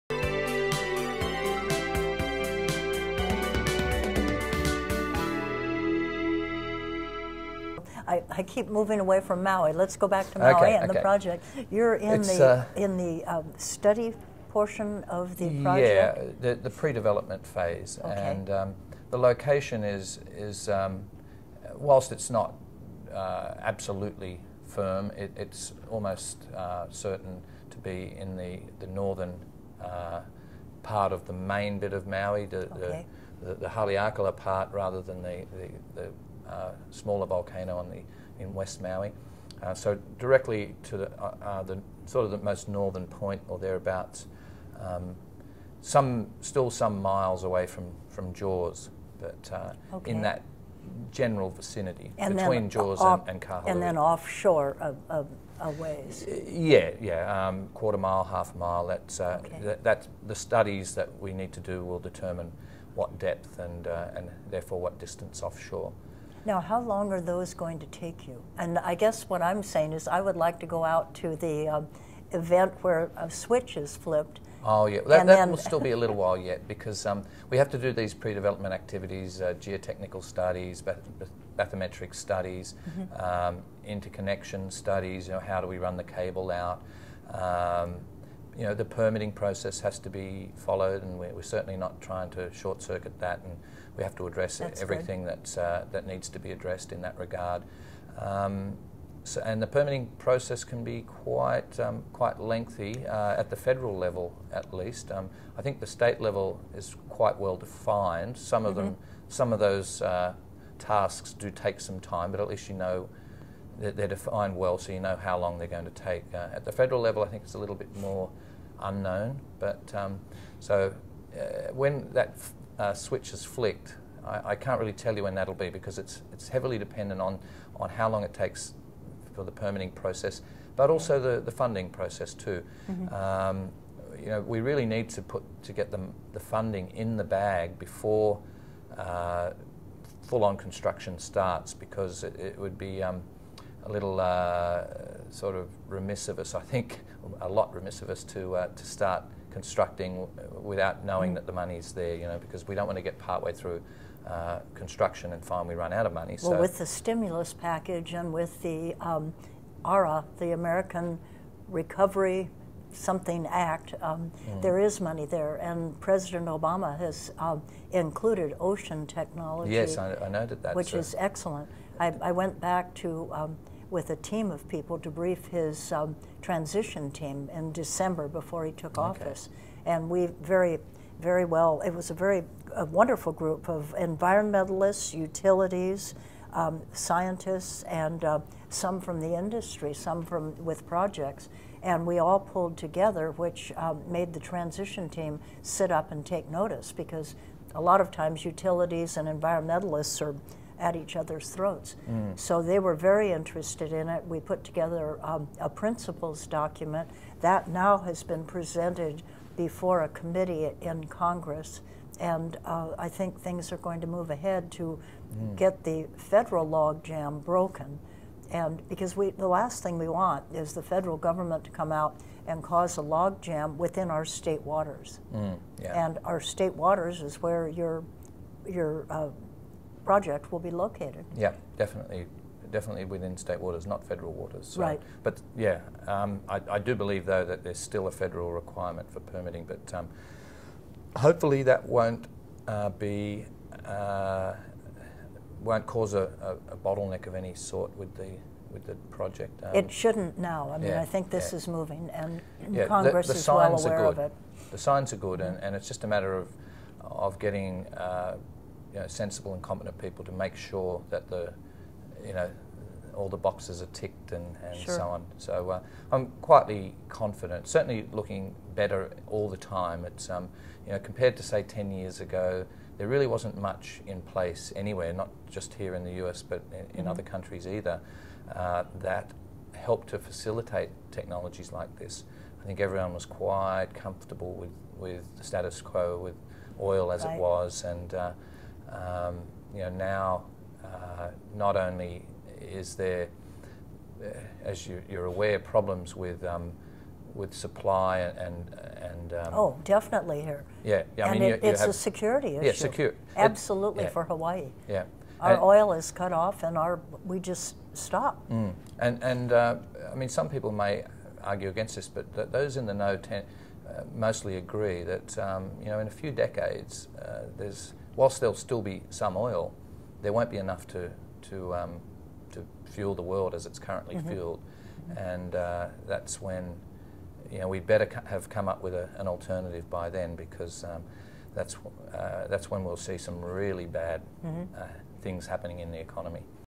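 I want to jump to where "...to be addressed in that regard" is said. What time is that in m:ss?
1:36.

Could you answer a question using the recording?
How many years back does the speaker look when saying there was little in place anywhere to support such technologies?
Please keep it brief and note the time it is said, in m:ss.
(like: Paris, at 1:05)
10 years, at 4:31.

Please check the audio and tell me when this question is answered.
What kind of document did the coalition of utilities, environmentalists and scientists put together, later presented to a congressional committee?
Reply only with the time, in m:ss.
3:25.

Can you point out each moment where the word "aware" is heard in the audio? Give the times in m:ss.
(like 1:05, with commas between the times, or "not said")
4:13, 4:55.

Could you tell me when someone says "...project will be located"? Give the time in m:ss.
3:50.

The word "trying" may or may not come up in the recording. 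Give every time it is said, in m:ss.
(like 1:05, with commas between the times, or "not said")
1:32.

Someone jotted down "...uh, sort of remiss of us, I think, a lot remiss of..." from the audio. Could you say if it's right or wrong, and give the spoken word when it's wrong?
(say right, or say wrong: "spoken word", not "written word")
right.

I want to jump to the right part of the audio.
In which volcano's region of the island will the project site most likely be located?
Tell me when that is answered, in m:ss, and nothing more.
0:33.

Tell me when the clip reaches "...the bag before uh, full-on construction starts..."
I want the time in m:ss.
2:17.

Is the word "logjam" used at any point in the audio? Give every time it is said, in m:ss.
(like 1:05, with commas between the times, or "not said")
3:36, 3:43.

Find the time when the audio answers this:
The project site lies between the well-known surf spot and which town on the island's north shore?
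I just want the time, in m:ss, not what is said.
0:53.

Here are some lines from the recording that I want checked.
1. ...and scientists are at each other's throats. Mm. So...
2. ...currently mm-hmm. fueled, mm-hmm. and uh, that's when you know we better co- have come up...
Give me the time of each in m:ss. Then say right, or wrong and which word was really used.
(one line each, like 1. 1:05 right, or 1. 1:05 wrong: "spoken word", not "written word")
1. 3:19 wrong: "environmentalists", not "scientists"
2. 5:23 right.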